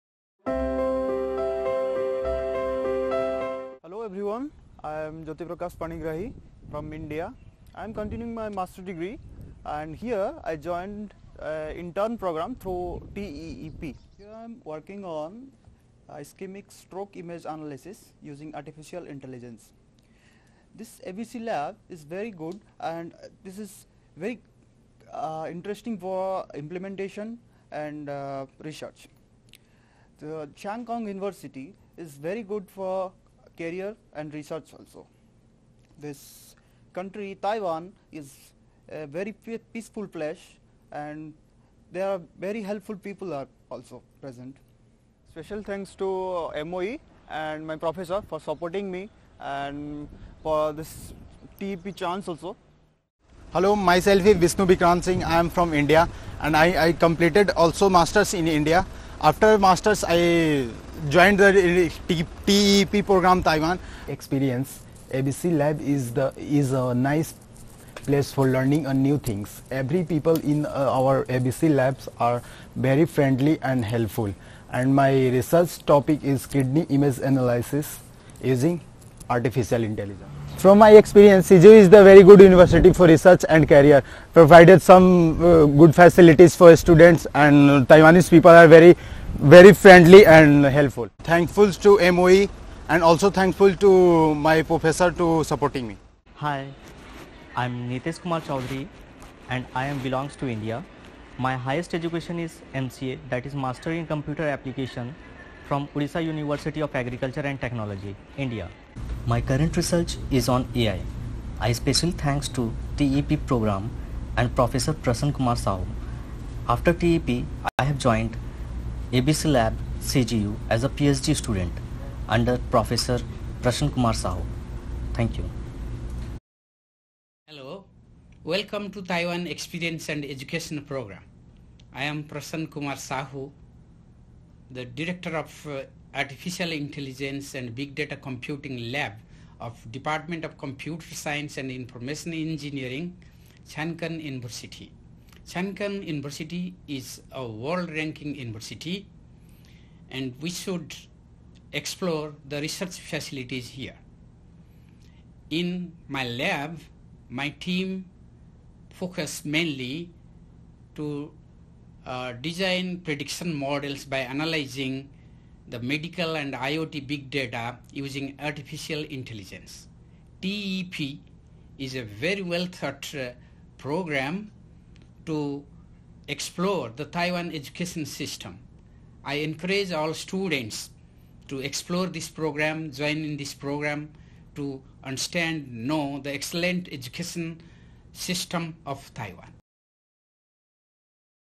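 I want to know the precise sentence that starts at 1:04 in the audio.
Experience ABC Lab is the is a nice place for learning a new things.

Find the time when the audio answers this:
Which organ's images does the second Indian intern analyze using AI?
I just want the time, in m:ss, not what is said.
1:16.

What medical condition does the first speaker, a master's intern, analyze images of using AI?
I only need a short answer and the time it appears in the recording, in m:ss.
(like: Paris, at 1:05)
Ischemic stroke, at 0:16.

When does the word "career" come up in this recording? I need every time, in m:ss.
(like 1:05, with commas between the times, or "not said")
0:33, 1:23.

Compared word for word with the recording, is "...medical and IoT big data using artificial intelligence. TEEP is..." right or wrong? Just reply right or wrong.
right.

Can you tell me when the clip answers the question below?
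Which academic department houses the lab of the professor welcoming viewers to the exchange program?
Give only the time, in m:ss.
2:20.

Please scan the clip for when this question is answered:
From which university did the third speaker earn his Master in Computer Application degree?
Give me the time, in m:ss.
1:45.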